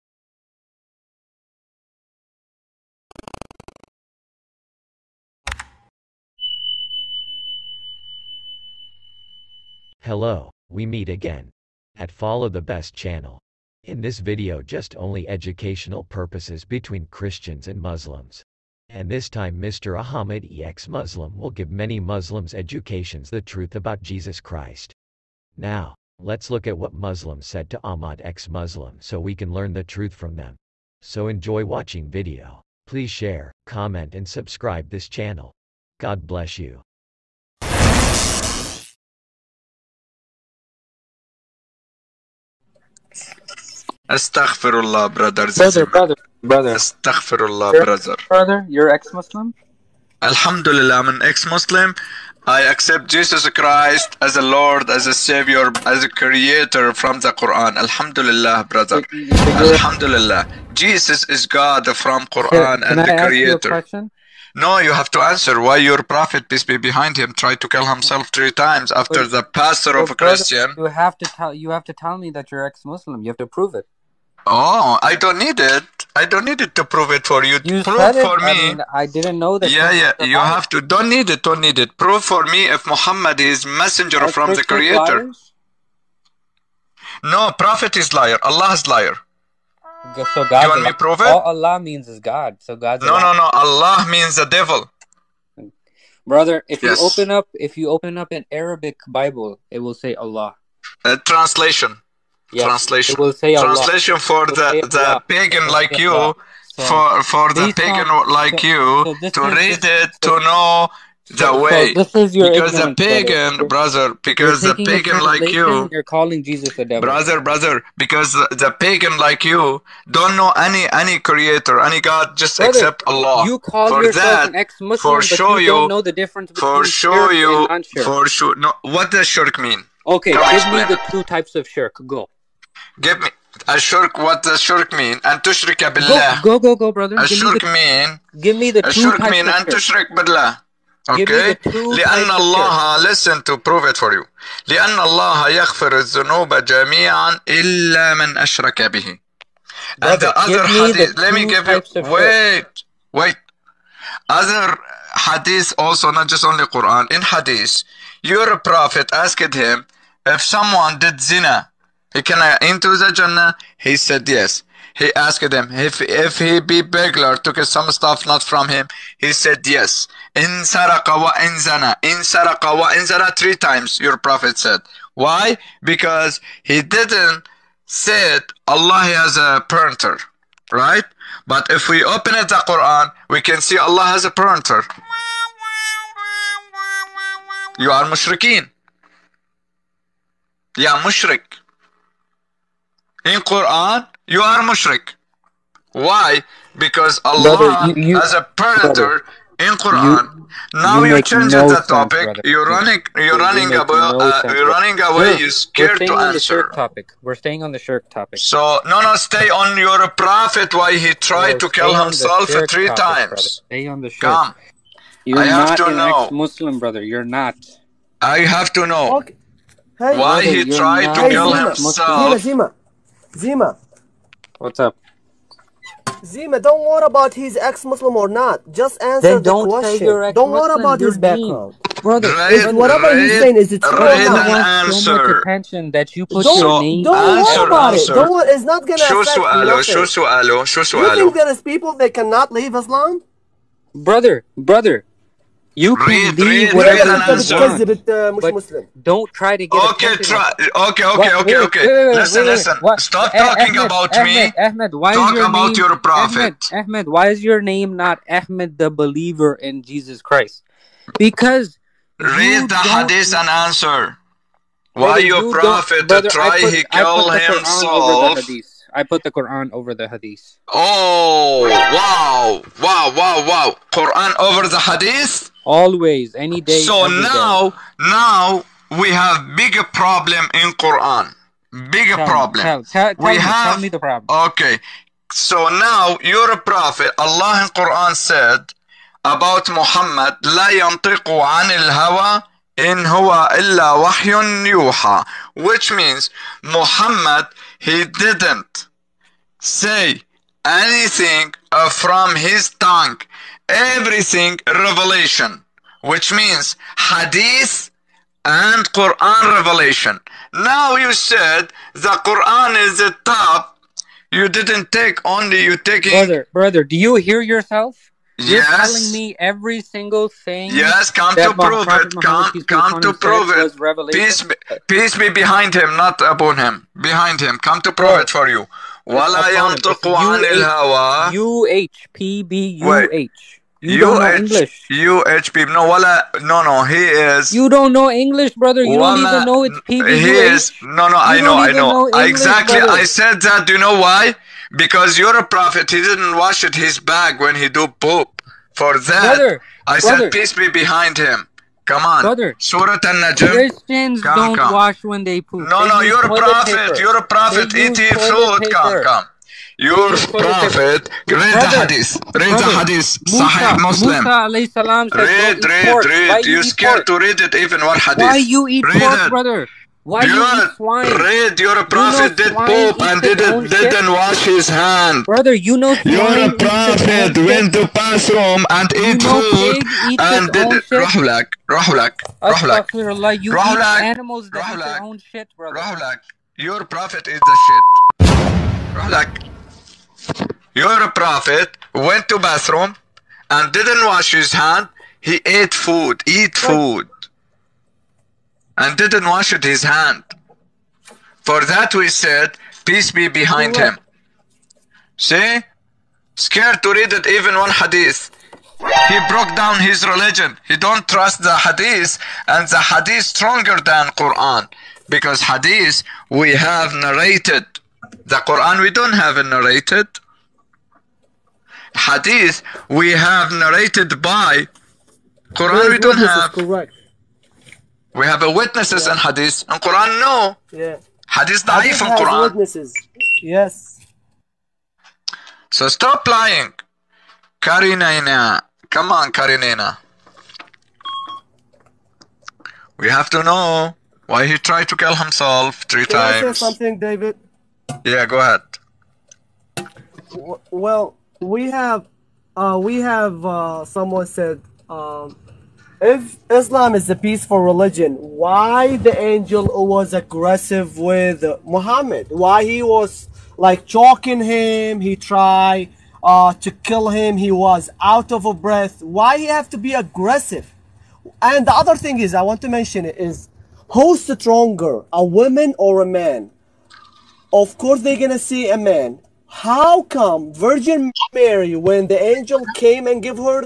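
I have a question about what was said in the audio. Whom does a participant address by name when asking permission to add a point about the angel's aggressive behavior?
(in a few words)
David.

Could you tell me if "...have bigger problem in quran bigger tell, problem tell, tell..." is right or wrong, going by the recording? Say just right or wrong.
right.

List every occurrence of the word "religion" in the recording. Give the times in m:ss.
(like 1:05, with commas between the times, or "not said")
6:50, 7:37.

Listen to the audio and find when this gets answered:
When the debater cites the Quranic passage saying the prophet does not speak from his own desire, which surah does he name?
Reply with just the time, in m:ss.
5:52.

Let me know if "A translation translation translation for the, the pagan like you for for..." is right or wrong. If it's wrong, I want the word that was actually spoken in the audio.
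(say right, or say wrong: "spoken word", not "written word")
right.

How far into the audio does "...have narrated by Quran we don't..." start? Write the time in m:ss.
7:03.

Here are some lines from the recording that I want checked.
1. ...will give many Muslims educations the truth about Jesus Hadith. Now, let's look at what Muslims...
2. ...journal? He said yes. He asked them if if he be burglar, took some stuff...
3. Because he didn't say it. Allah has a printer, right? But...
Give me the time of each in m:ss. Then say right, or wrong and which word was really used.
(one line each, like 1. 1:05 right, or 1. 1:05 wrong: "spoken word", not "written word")
1. 0:21 wrong: "Christ", not "Hadith"
2. 2:43 right
3. 2:55 right.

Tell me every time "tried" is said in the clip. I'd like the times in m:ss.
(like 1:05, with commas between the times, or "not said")
1:07, 3:31, 3:40, 7:24, 7:45.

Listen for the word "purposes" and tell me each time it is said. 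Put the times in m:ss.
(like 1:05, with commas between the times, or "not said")
0:16.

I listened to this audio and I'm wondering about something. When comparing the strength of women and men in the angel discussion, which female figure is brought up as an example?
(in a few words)
Virgin Mary.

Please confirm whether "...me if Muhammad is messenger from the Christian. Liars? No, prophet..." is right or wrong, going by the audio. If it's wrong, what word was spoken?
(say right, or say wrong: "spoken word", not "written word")
wrong: "Creator", not "Christian".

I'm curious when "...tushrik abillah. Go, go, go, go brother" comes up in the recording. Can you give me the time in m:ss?
2:15.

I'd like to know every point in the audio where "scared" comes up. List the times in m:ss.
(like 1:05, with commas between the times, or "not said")
3:25, 6:06, 6:46.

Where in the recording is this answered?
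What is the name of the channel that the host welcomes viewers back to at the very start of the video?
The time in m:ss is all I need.
0:12.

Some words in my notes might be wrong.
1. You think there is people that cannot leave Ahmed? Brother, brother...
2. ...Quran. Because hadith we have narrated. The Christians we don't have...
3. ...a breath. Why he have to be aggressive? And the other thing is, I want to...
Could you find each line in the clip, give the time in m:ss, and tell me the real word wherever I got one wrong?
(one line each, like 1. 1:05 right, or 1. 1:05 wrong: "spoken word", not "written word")
1. 4:01 wrong: "Islam", not "Ahmed"
2. 6:54 wrong: "Quran", not "Christians"
3. 7:48 right.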